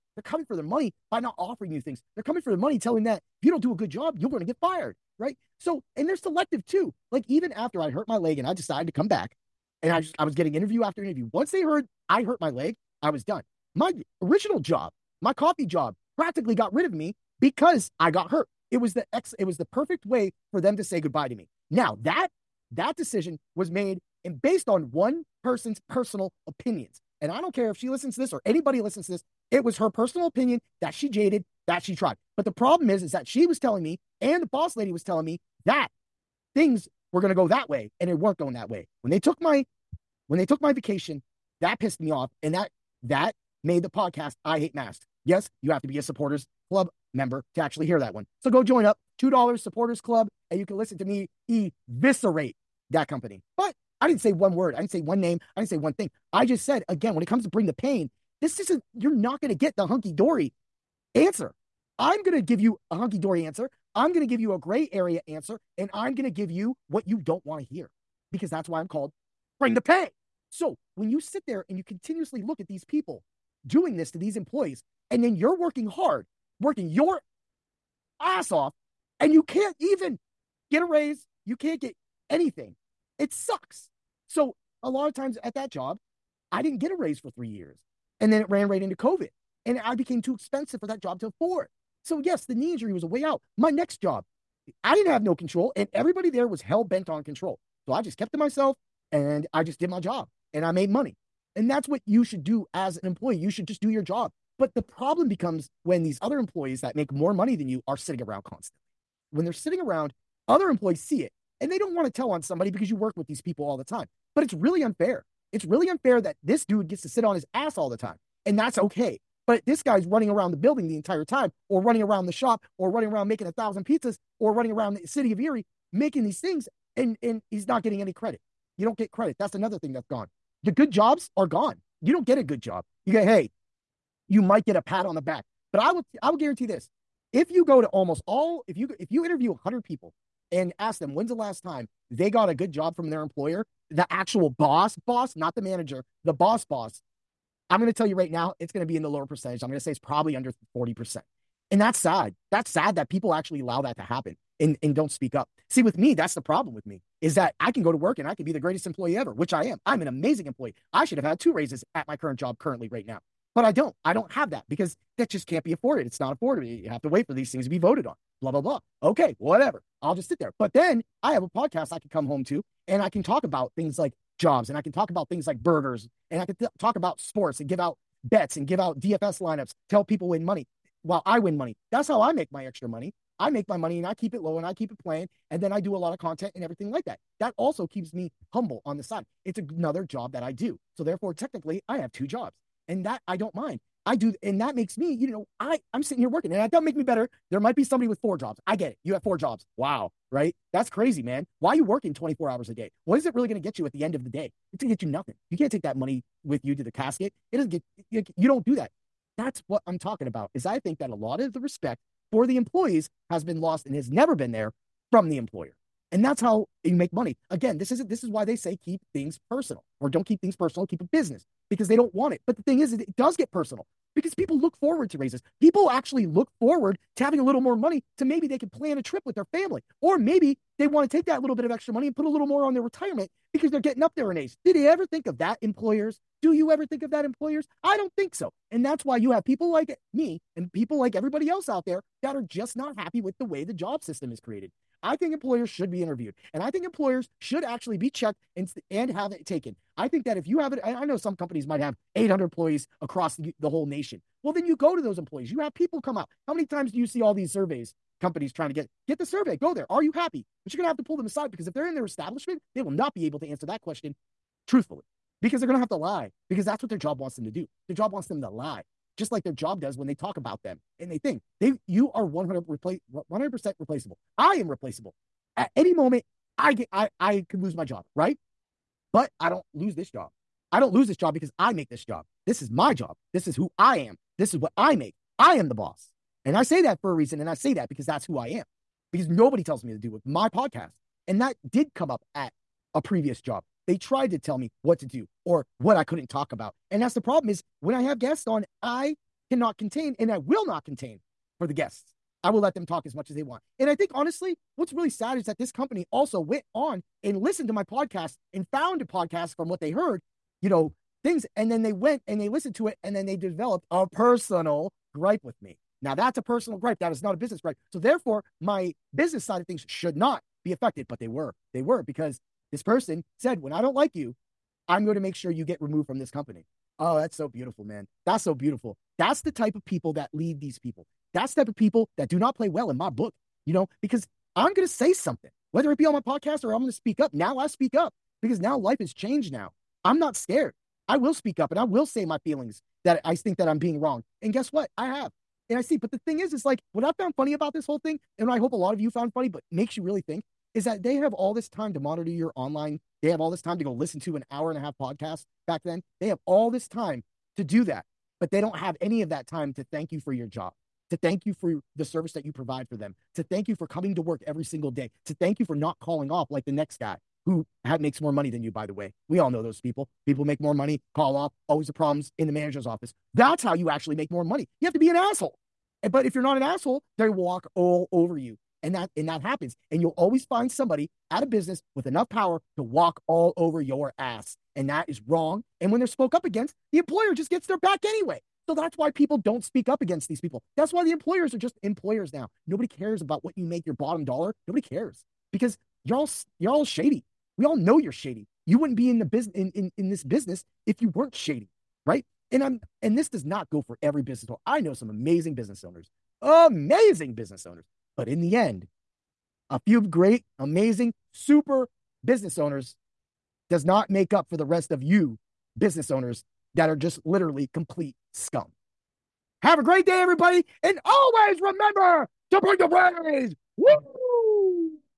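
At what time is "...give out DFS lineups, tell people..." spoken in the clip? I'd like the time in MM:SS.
02:58.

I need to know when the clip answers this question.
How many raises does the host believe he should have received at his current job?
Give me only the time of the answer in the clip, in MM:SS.
02:41.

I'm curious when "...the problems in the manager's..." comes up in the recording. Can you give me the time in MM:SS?
06:11.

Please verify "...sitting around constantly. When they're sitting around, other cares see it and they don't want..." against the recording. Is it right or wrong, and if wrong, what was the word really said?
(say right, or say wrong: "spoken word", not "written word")
wrong: "employees", not "cares".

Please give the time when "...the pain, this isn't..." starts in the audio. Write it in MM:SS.
00:57.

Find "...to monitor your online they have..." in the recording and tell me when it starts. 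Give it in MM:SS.
05:51.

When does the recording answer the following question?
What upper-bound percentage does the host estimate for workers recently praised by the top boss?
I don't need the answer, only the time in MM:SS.
02:30.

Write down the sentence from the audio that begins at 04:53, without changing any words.
They tried to tell me what to do or what I couldn't talk about.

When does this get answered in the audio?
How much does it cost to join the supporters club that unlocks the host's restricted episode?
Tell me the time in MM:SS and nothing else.
00:49.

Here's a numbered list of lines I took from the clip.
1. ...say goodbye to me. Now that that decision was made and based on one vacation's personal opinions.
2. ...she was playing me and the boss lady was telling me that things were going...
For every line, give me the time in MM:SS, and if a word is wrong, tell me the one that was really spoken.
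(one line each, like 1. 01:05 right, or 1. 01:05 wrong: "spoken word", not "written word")
1. 00:20 wrong: "person", not "vacation"
2. 00:33 wrong: "telling", not "playing".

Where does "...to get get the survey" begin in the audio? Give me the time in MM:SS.
04:18.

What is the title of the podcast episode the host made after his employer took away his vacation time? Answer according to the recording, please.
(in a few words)
I Hate Masks.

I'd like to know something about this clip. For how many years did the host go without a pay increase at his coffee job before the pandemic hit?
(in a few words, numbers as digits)
3.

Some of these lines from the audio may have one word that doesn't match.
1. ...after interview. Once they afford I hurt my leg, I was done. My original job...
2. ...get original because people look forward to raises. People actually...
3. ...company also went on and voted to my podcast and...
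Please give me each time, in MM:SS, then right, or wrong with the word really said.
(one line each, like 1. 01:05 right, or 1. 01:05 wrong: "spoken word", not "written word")
1. 00:10 wrong: "heard", not "afford"
2. 03:43 wrong: "personal", not "original"
3. 05:05 wrong: "listened", not "voted".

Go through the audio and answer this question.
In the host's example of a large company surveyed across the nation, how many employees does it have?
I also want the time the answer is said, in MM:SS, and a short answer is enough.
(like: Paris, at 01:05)
800, at 04:12.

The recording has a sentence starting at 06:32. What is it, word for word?
Nobody cares about what you make your bottom dollar.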